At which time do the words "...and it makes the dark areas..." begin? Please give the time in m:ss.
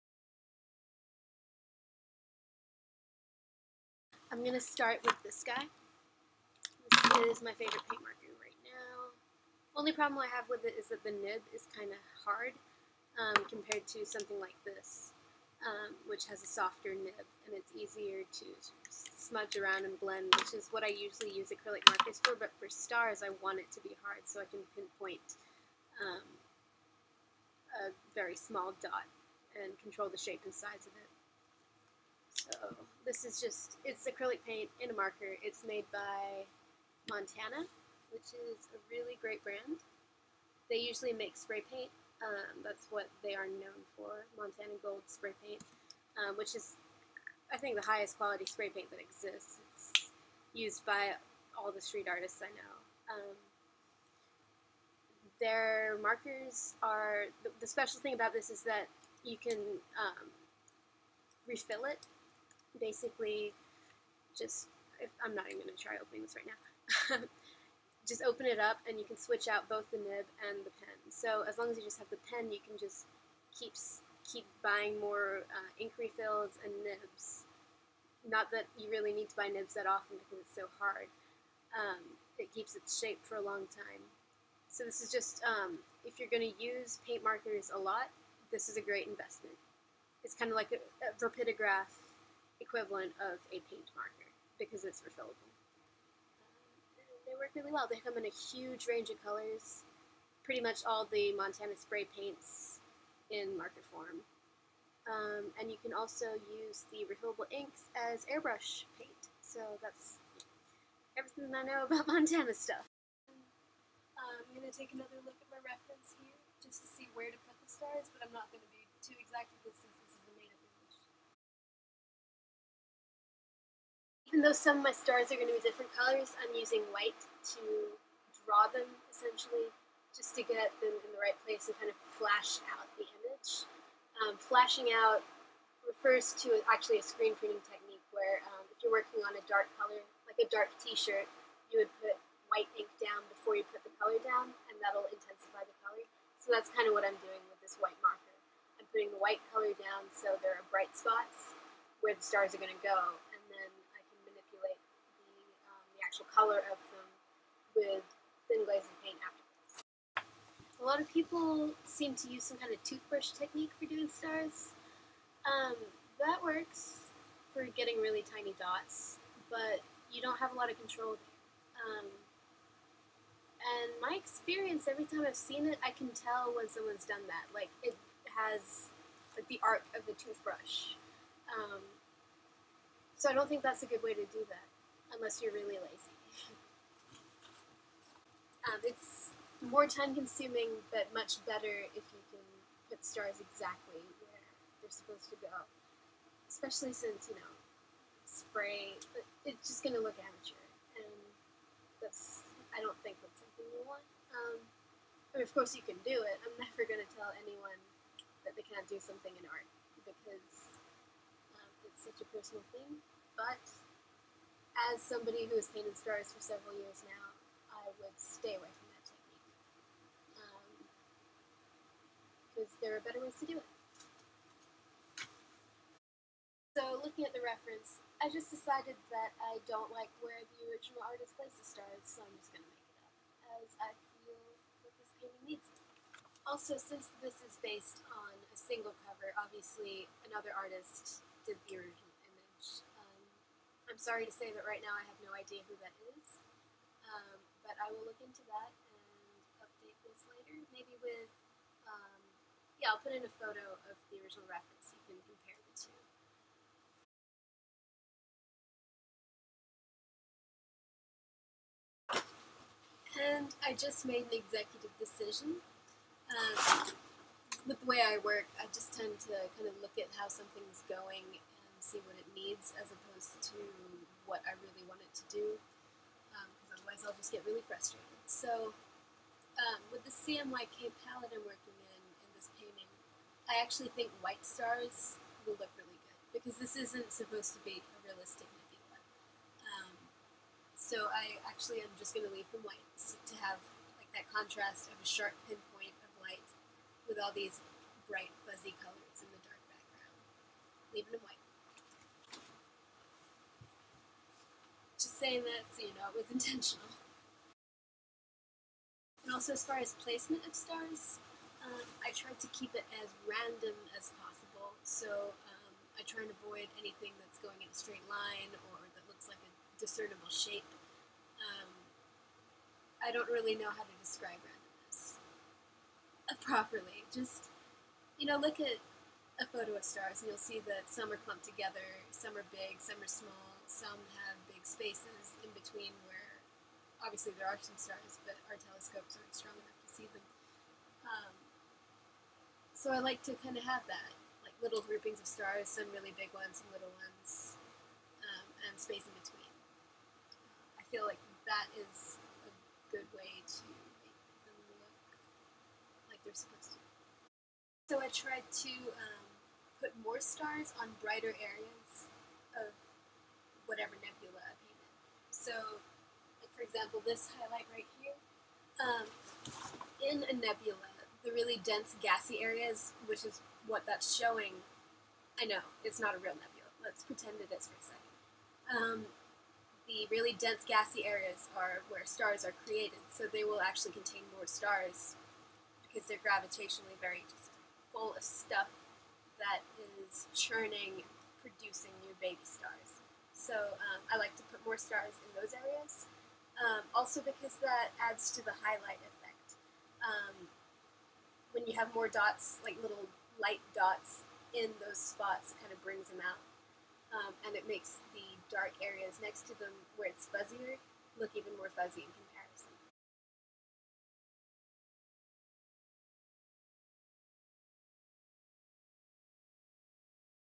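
6:47.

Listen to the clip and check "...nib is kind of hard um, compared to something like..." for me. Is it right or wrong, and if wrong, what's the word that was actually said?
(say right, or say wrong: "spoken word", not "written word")
right.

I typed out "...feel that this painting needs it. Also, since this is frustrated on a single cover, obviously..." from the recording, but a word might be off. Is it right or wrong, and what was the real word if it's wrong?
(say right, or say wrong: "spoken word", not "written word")
wrong: "based", not "frustrated".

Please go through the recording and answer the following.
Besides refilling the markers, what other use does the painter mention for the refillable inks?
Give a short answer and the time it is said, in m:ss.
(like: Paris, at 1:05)
Airbrush paint, at 1:48.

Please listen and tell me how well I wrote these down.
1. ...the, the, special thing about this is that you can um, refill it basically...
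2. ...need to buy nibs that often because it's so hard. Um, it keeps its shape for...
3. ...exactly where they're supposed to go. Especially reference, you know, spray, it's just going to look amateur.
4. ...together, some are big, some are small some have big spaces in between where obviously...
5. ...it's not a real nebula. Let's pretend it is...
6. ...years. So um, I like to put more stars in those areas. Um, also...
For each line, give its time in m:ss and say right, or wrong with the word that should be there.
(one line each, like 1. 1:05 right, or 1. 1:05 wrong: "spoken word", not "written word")
1. 0:57 right
2. 1:19 right
3. 3:13 wrong: "since", not "reference"
4. 5:31 right
5. 6:15 right
6. 6:32 wrong: "stars", not "years".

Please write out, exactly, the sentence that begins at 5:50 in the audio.
I feel like that is a good way to make them look like they're supposed to.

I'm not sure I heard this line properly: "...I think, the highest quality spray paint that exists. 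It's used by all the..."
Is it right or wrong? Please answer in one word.
right.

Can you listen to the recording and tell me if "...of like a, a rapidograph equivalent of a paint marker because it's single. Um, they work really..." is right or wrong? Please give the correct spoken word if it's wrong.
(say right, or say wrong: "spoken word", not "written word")
wrong: "refillable", not "single".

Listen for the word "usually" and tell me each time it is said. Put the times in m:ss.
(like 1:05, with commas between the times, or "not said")
0:20, 0:40.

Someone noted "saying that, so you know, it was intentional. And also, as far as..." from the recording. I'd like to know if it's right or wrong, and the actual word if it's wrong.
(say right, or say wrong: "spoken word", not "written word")
right.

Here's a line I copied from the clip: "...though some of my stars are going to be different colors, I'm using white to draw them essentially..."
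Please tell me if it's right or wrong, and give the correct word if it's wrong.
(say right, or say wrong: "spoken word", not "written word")
right.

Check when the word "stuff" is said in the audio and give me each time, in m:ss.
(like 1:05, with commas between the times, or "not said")
1:52, 6:28.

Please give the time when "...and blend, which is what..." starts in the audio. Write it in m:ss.
0:19.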